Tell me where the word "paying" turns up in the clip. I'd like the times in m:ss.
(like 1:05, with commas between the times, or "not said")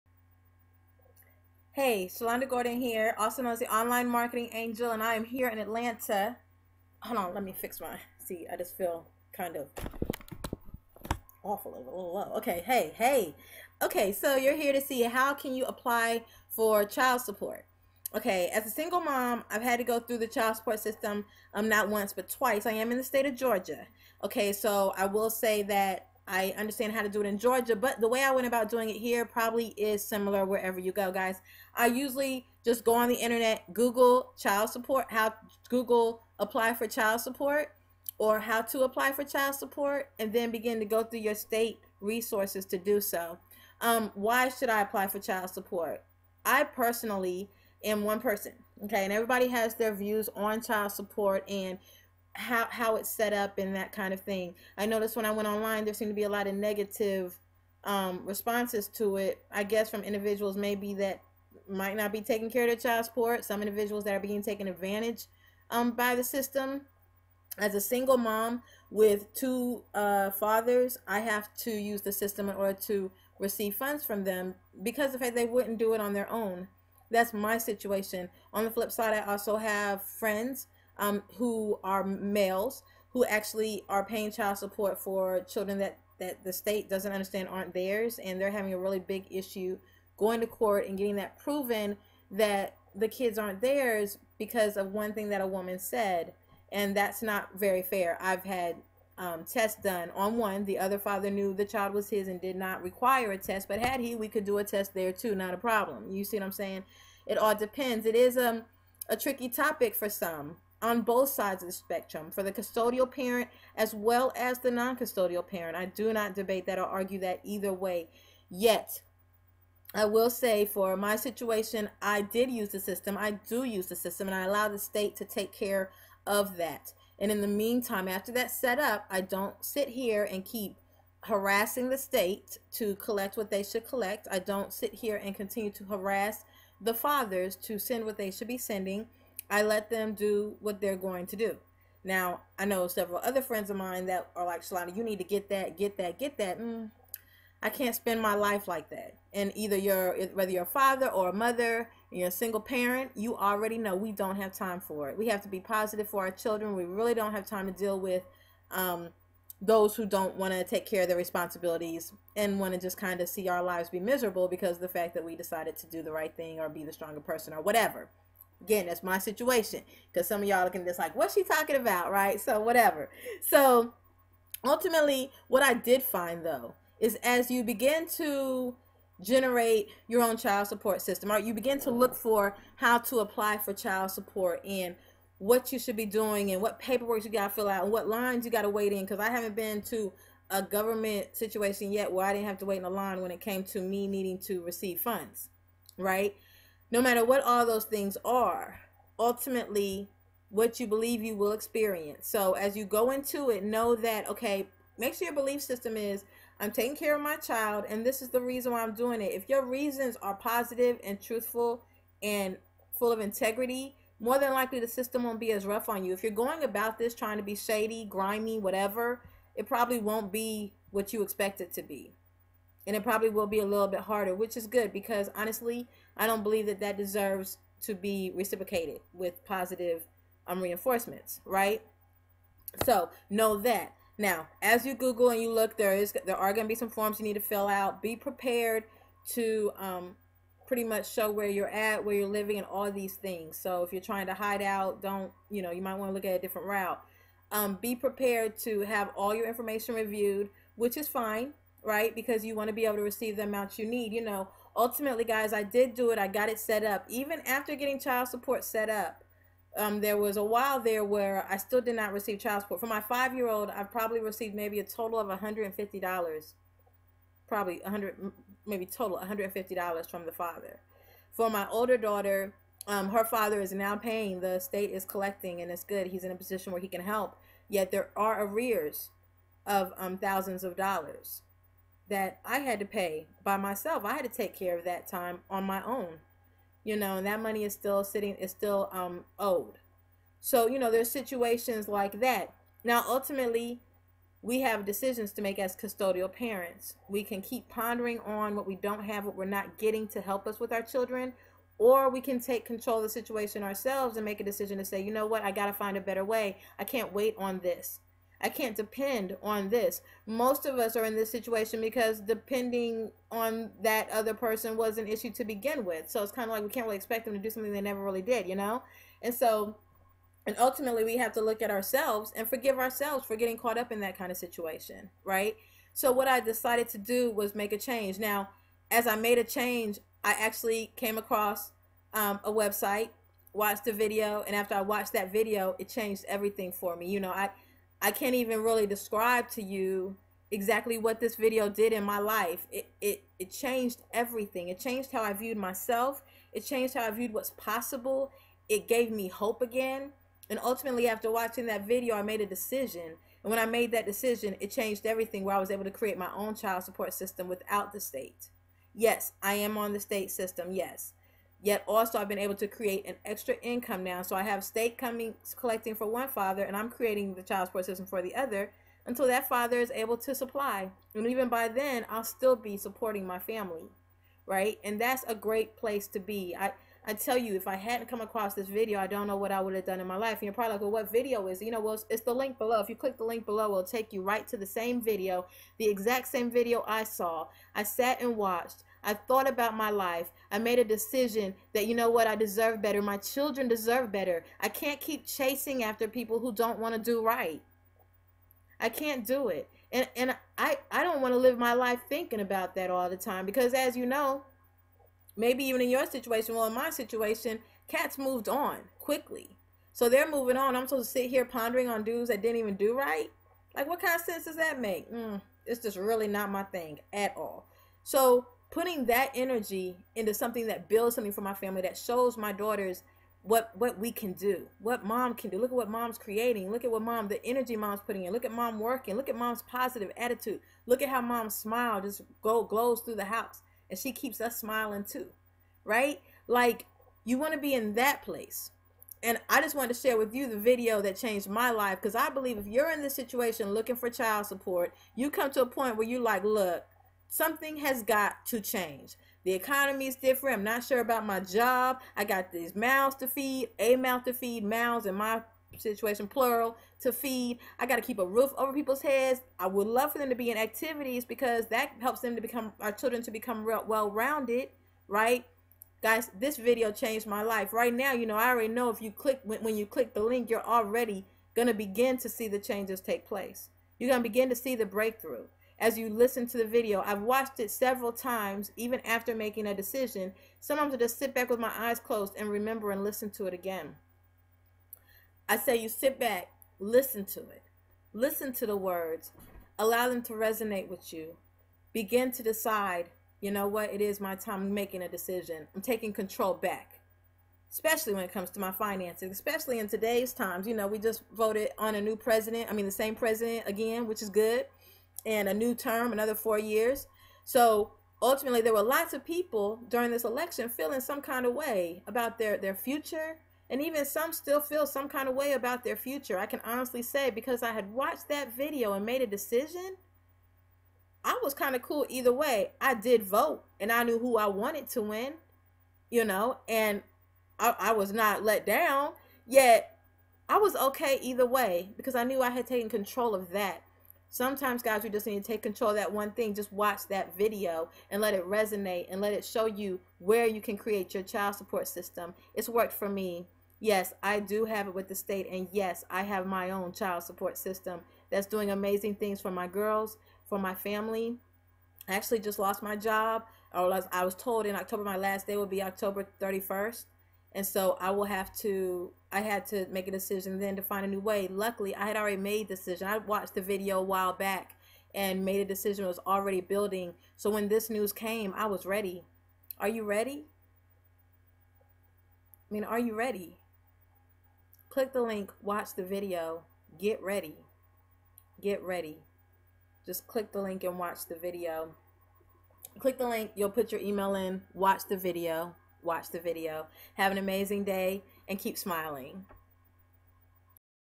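1:24, 4:33.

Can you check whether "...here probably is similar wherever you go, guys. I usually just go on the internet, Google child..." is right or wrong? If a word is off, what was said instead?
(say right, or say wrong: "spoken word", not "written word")
right.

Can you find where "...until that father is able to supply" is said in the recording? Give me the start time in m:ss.
6:09.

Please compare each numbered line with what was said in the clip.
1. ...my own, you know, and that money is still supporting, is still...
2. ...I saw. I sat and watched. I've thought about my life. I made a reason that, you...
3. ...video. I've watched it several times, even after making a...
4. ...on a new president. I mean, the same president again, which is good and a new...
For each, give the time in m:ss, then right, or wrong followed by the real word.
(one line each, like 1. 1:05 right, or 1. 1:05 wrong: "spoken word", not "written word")
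1. 4:45 wrong: "sitting", not "supporting"
2. 6:26 wrong: "decision", not "reason"
3. 7:56 right
4. 8:21 right.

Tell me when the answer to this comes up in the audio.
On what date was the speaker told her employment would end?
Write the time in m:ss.
9:15.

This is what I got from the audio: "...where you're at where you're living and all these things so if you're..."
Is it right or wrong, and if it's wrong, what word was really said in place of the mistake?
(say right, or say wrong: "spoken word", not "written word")
right.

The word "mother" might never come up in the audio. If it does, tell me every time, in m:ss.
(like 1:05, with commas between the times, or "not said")
2:31.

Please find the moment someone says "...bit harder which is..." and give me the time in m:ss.
3:43.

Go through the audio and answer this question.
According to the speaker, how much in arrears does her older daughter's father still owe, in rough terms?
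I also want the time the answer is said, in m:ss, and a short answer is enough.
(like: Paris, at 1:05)
thousands of dollars, at 4:40.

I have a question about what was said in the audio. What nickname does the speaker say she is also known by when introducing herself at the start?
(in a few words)
Online Marketing Angel.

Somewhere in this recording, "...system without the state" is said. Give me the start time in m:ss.
5:57.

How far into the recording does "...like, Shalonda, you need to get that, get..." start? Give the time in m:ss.
2:24.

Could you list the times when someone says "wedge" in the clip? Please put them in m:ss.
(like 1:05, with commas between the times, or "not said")
not said.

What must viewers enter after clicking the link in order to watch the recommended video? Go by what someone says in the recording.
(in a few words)
email.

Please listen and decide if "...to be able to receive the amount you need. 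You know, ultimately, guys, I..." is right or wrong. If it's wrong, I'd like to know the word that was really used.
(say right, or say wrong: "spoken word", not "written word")
right.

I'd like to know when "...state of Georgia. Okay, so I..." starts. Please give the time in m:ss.
0:23.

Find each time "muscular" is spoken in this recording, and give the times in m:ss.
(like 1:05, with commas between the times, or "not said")
not said.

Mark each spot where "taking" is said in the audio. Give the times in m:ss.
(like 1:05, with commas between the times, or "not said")
1:02, 3:26, 8:15.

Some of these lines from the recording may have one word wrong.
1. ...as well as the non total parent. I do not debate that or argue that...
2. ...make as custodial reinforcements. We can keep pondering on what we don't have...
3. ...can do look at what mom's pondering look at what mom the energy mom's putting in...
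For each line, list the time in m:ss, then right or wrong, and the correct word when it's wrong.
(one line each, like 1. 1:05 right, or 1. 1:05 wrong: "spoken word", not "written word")
1. 1:53 wrong: "custodial", not "total"
2. 4:55 wrong: "parents", not "reinforcements"
3. 7:05 wrong: "creating", not "pondering".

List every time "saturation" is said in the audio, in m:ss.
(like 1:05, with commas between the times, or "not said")
not said.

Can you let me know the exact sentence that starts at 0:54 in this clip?
I noticed when I went online, there seemed to be a lot of negative um, responses to it.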